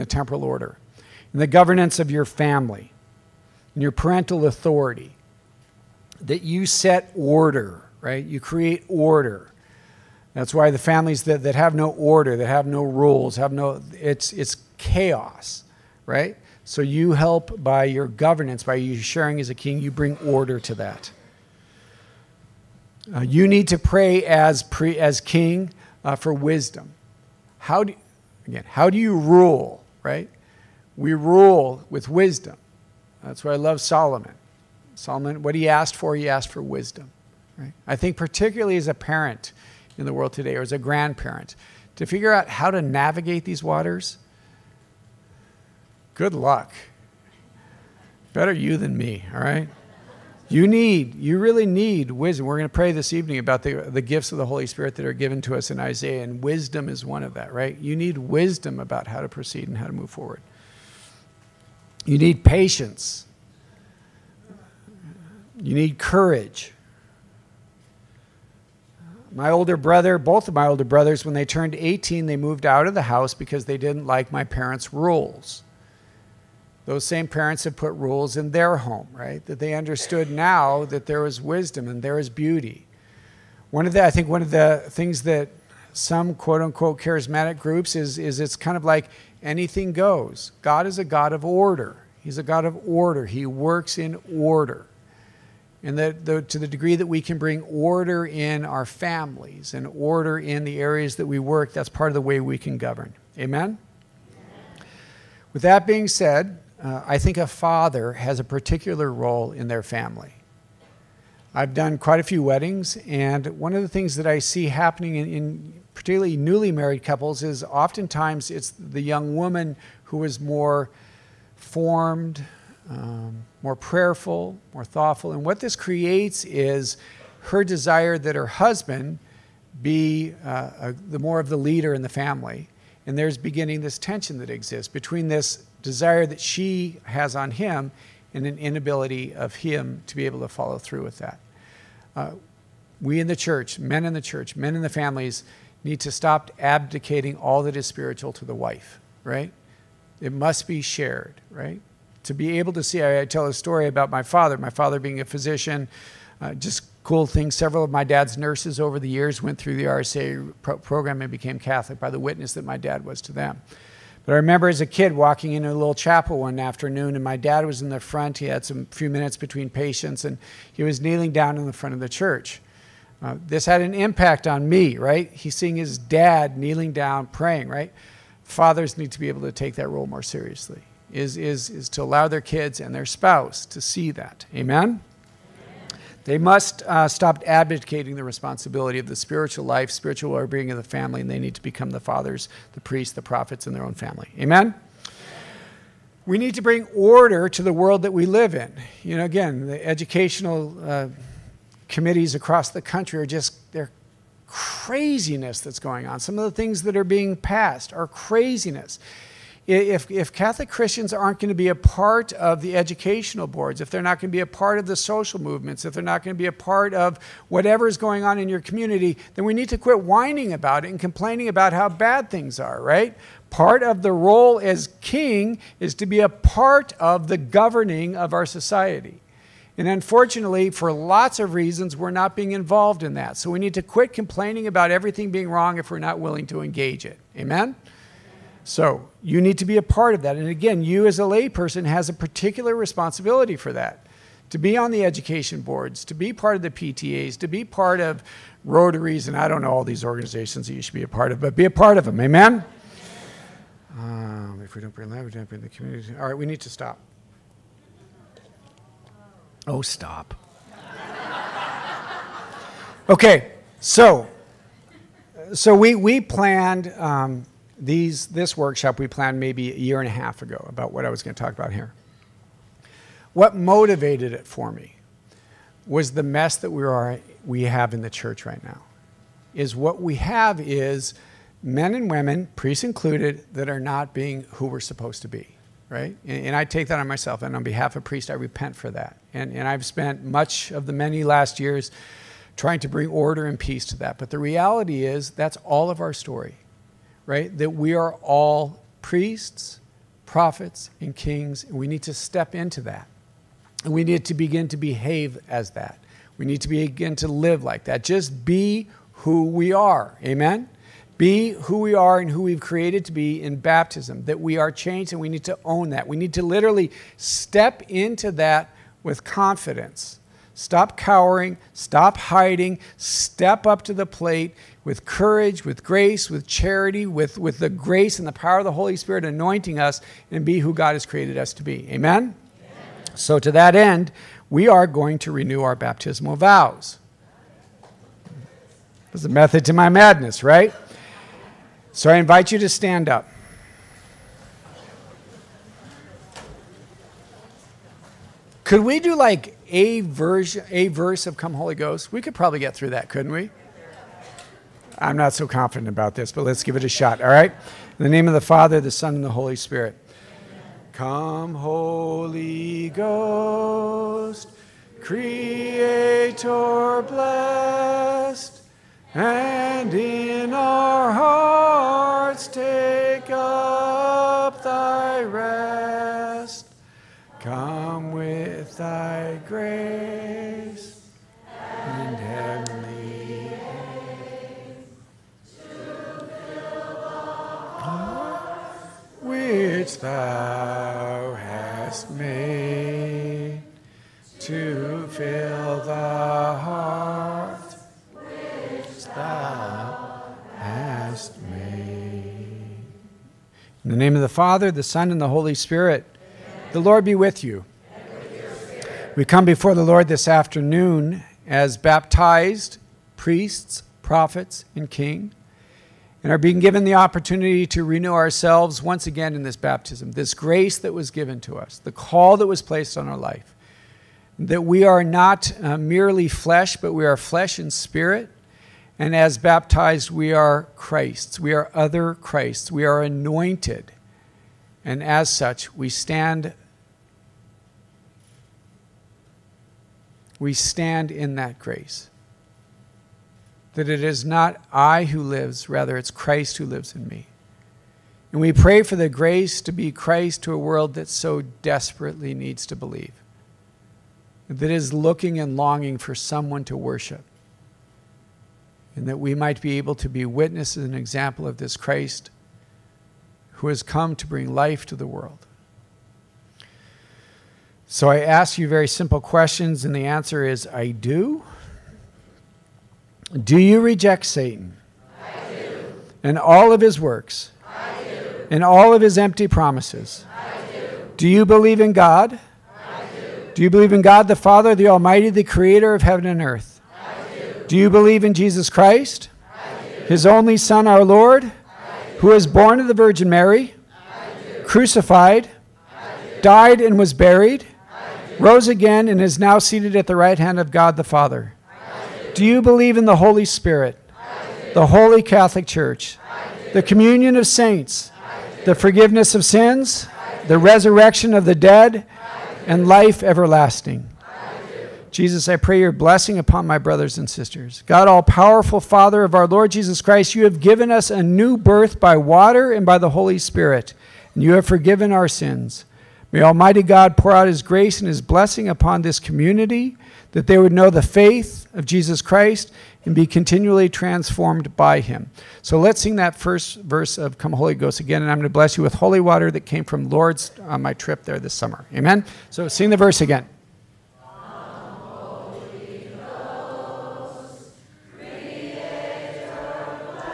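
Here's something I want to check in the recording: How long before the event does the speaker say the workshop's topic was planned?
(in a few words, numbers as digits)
A year and a half.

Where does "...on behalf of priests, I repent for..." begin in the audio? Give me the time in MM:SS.
04:47.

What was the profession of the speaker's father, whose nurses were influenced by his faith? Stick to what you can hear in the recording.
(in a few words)
Physician.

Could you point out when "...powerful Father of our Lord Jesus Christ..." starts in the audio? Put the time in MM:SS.
08:38.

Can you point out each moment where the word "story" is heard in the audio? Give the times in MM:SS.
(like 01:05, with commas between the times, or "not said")
02:33, 04:56.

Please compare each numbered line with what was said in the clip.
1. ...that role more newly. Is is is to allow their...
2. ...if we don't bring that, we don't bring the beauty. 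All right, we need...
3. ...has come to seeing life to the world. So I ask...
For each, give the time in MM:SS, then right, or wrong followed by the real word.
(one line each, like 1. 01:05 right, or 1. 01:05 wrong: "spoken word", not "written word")
1. 02:59 wrong: "seriously", not "newly"
2. 04:14 wrong: "community", not "beauty"
3. 07:43 wrong: "bring", not "seeing".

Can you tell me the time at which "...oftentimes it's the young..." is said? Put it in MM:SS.
01:57.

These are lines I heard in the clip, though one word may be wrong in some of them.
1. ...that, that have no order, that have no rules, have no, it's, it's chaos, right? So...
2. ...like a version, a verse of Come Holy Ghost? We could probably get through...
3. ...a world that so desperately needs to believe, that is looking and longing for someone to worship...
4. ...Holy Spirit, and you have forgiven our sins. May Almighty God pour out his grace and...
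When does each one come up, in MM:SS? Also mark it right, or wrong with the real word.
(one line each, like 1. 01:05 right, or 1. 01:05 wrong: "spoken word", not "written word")
1. 00:11 right
2. 05:49 right
3. 07:30 right
4. 08:43 right.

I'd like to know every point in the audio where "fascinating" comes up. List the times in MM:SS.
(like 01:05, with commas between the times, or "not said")
not said.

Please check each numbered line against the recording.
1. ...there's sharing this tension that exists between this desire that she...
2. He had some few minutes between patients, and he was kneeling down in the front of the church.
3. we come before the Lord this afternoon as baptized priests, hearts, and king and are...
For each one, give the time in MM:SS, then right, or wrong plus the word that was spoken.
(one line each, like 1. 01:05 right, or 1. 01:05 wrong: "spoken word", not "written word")
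1. 02:13 wrong: "beginning", not "sharing"
2. 02:48 right
3. 06:49 wrong: "prophets", not "hearts".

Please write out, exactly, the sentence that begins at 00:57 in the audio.
You need wisdom about how to proceed and how to move forward.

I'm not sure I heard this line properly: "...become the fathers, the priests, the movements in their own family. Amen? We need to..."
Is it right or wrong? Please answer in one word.
wrong.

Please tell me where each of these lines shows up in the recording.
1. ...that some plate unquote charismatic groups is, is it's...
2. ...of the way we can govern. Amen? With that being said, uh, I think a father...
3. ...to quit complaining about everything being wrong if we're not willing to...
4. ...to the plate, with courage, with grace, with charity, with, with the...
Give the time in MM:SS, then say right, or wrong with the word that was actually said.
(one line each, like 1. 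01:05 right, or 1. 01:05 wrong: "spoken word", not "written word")
1. 01:25 wrong: "quote", not "plate"
2. 01:42 right
3. 03:53 right
4. 05:23 right.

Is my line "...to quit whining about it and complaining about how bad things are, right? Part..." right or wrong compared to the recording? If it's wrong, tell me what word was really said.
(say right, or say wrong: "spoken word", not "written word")
right.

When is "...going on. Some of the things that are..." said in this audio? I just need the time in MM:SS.
03:25.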